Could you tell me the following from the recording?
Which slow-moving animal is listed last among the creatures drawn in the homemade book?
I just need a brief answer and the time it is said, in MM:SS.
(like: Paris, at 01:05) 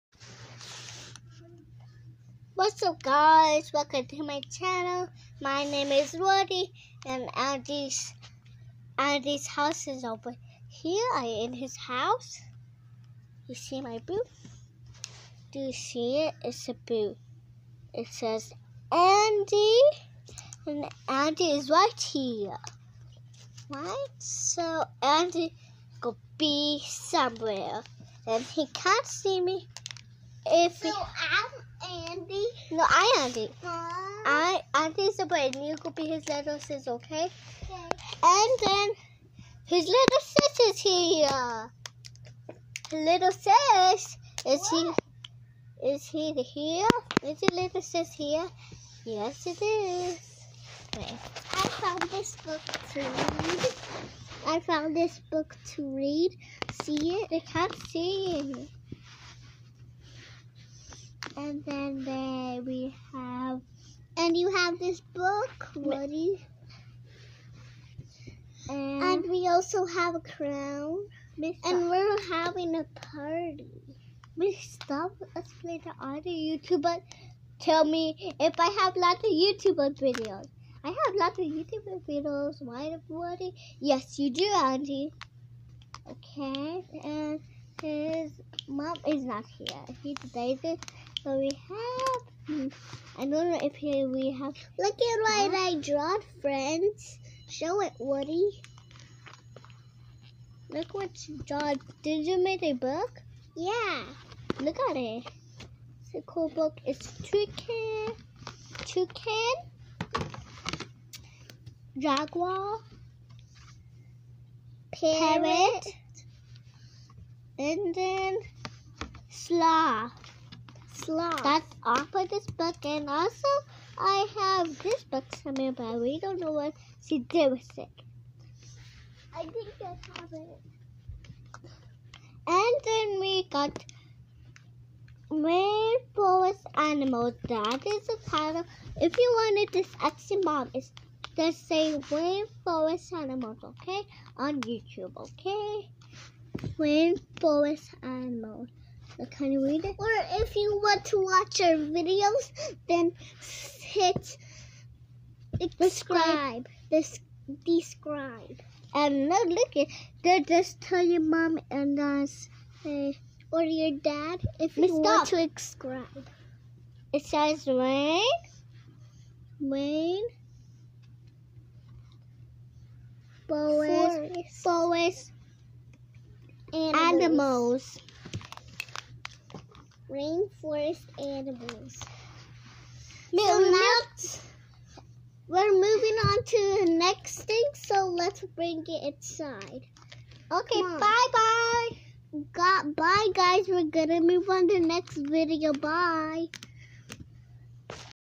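Sloth, at 01:59.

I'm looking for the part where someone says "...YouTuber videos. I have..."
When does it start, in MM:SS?
01:19.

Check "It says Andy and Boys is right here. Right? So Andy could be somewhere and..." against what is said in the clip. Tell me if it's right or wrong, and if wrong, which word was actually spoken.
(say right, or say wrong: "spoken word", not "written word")
wrong: "Andy", not "Boys".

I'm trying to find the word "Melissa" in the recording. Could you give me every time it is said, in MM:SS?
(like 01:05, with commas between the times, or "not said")
not said.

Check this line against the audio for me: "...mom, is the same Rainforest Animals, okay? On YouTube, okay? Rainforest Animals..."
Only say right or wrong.
right.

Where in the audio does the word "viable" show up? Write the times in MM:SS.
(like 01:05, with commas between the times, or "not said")
not said.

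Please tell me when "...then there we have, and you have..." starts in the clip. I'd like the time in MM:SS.
01:01.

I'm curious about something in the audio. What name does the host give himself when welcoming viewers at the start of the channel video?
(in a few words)
Roddy.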